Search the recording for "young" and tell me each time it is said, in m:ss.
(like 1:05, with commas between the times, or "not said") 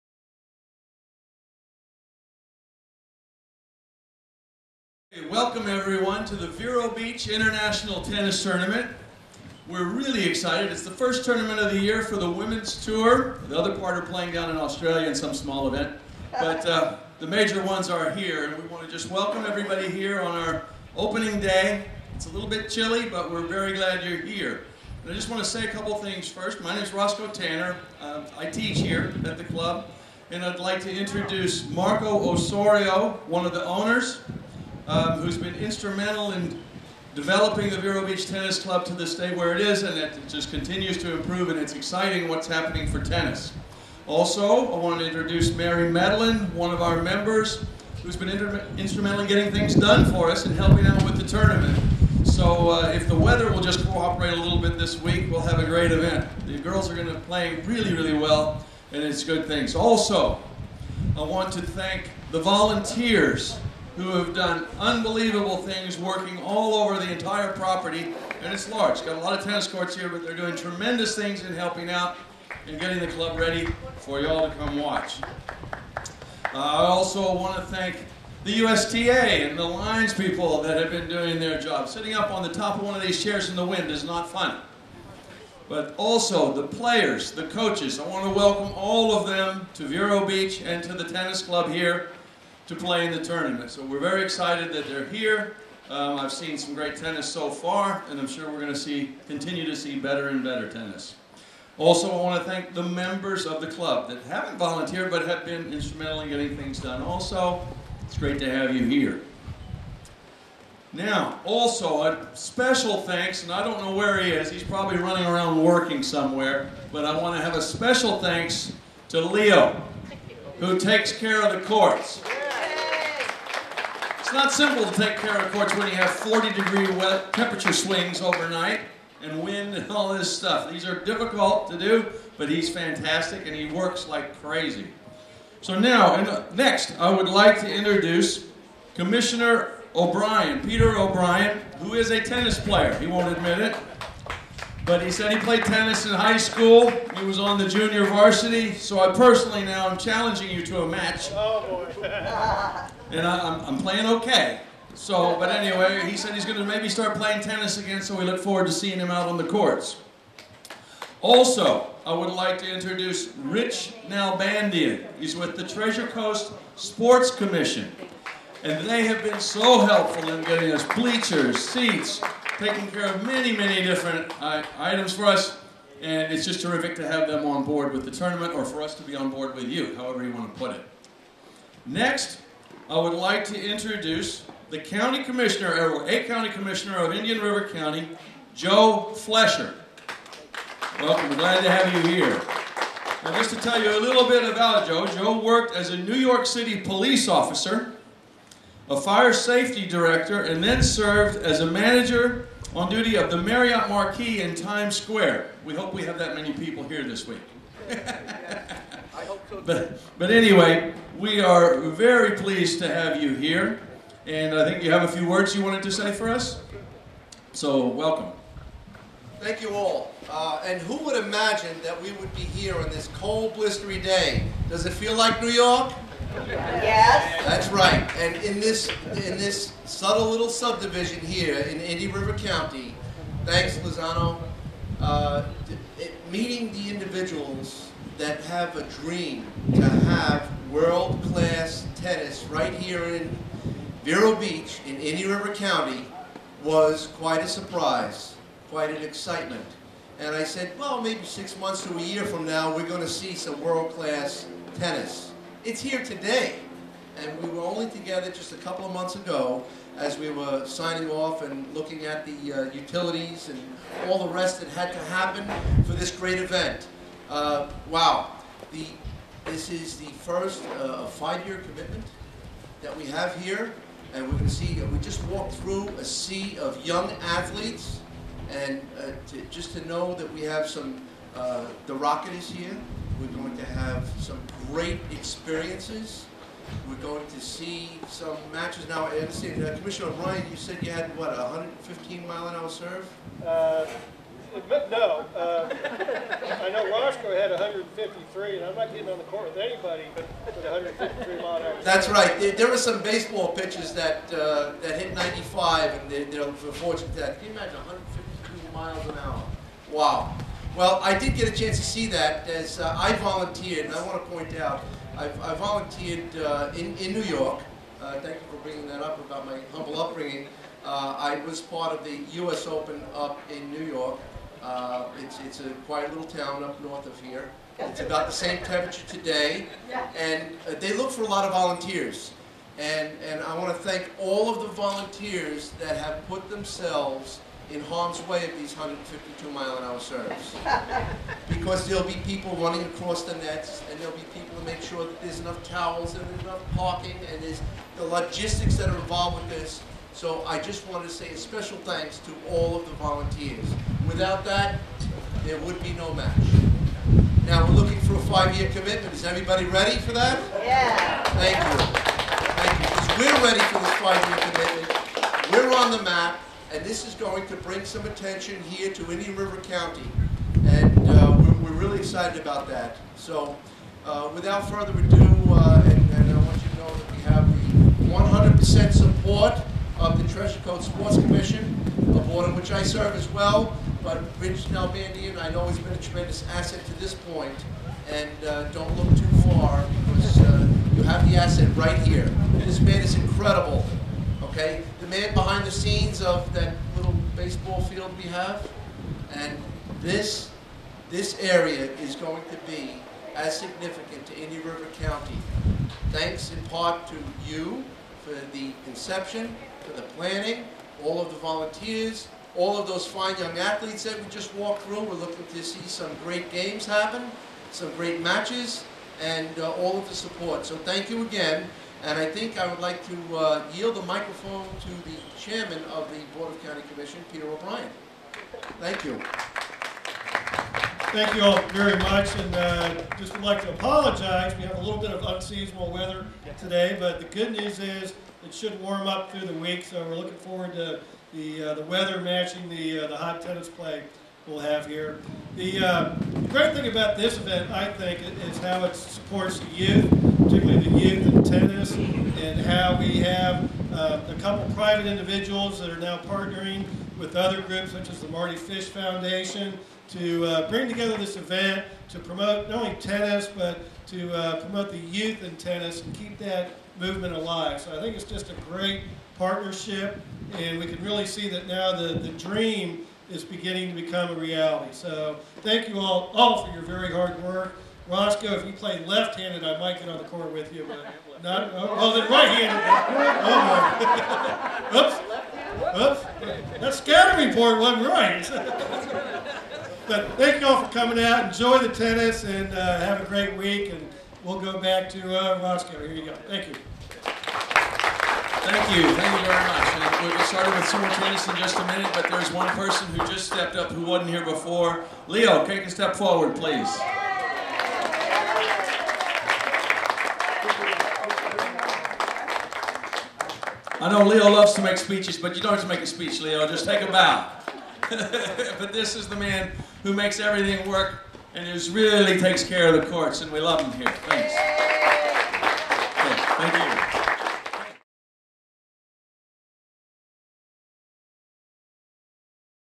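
4:36, 6:53.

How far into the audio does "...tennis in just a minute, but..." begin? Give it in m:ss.
8:21.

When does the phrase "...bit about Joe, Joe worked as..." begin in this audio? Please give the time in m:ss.
3:14.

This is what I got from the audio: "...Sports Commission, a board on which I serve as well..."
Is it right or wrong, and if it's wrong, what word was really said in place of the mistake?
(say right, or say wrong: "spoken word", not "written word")
right.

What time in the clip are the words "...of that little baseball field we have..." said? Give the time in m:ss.
6:36.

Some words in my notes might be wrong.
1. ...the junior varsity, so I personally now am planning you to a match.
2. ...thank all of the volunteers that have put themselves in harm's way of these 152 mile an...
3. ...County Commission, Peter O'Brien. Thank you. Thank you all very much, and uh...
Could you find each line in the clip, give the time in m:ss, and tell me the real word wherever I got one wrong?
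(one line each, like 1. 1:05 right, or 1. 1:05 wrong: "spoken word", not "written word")
1. 2:27 wrong: "challenging", not "planning"
2. 5:33 right
3. 7:06 right.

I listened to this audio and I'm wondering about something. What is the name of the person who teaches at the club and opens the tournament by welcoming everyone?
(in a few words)
Roscoe Tanner.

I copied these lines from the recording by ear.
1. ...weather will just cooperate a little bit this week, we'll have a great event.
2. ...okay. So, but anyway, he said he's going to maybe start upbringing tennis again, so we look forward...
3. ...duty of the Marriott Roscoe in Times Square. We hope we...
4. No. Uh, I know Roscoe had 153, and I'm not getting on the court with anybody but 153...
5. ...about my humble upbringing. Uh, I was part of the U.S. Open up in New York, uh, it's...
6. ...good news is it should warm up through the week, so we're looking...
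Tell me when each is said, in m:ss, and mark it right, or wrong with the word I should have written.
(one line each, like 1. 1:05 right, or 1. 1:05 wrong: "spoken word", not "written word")
1. 0:53 right
2. 2:34 wrong: "playing", not "upbringing"
3. 3:22 wrong: "Marquis", not "Roscoe"
4. 4:54 right
5. 5:19 right
6. 7:17 right.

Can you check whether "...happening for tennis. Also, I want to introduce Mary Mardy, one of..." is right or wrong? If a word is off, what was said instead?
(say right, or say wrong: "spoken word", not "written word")
wrong: "Madeline", not "Mardy".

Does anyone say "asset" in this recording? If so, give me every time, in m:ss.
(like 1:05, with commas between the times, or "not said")
6:26, 6:31.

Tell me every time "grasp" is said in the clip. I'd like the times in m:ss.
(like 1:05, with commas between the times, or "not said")
not said.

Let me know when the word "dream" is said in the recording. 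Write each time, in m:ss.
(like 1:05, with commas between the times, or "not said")
3:58, 7:52.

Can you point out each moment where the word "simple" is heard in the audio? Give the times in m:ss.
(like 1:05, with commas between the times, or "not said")
2:04.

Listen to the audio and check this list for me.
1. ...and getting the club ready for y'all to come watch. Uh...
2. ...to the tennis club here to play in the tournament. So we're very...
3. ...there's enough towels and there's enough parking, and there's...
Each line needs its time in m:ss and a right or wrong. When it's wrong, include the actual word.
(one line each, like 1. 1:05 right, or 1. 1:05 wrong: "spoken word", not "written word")
1. 1:12 right
2. 1:30 right
3. 5:45 right.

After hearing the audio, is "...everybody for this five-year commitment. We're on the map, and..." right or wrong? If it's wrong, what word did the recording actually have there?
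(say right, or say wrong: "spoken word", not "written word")
wrong: "ready", not "everybody".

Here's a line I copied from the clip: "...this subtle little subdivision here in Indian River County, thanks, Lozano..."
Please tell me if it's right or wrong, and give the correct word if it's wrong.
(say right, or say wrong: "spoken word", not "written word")
right.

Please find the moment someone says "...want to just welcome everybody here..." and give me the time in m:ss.
0:18.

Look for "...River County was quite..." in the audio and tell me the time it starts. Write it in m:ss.
4:05.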